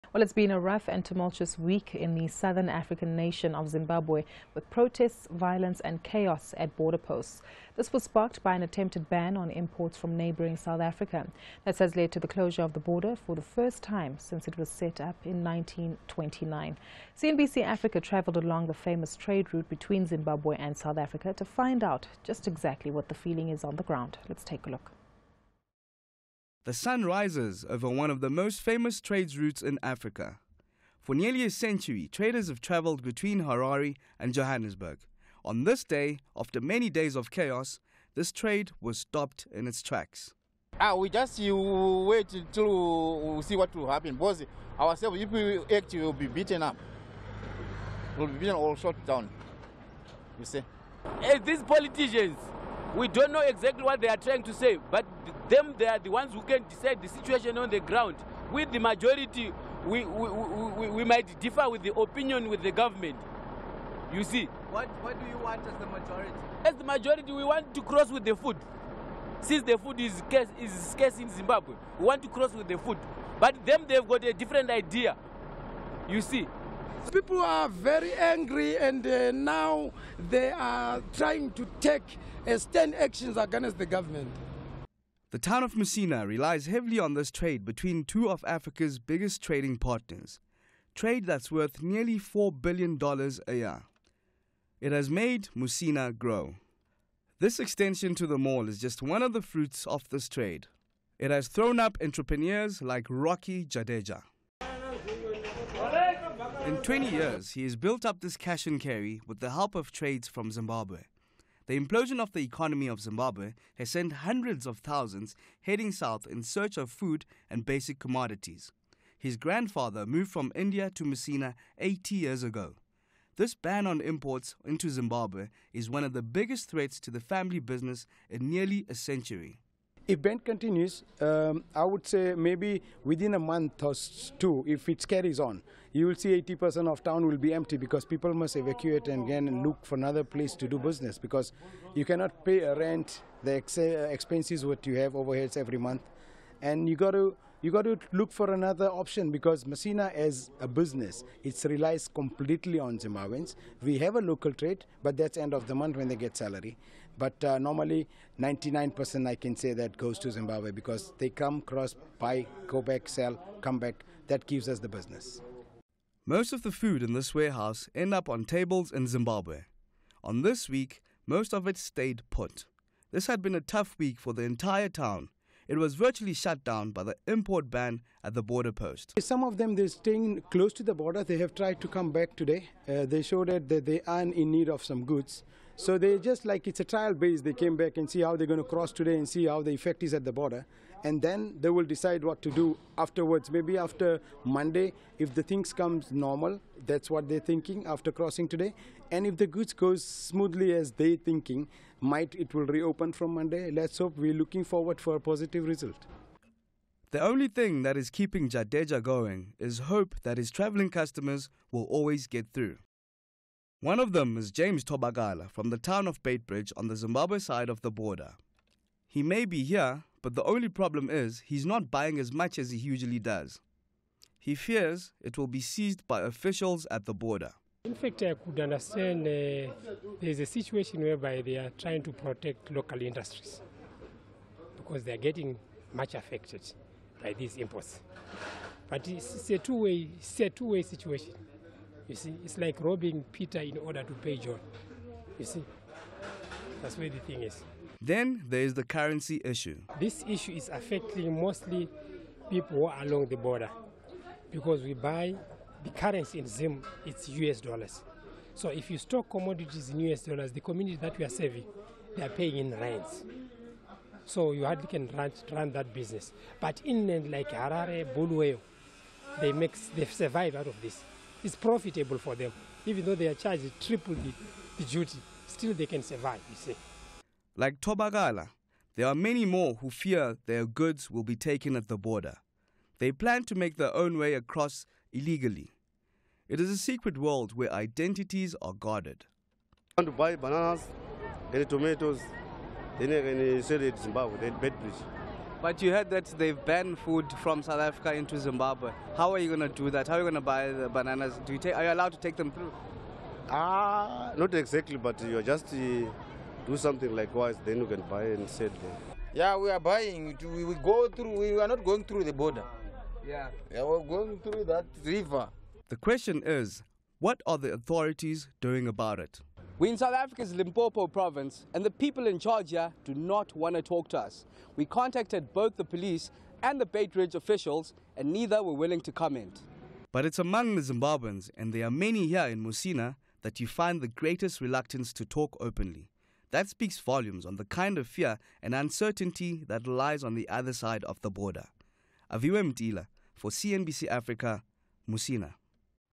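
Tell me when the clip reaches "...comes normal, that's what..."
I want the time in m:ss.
3:15.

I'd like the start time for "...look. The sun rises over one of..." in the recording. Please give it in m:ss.
0:24.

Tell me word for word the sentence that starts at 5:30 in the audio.
But it's among the Zimbabweans, and there are many here in Musina, that you find the greatest reluctance to talk openly.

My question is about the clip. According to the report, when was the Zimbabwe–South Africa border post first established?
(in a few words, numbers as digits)
1929.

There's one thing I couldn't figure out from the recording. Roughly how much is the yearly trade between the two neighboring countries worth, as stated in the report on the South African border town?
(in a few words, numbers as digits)
nearly $4 billion.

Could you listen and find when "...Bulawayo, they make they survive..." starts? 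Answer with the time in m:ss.
4:28.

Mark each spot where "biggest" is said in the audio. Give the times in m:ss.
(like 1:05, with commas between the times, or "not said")
1:28, 2:06.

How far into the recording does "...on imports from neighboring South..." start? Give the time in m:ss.
0:09.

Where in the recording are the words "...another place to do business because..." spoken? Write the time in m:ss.
2:19.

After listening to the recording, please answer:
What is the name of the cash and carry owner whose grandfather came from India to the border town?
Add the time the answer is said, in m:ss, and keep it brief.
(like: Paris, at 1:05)
Rocky Jadeja, at 1:43.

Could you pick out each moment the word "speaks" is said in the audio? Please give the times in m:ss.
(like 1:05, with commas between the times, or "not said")
5:36.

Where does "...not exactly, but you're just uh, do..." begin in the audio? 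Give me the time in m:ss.
5:04.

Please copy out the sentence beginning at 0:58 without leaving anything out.
With the majority, we, we, we, we might differ with the opinion with the government.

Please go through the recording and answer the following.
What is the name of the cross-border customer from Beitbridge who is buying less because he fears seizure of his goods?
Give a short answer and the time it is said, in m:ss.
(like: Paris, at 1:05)
James Tobagala, at 3:34.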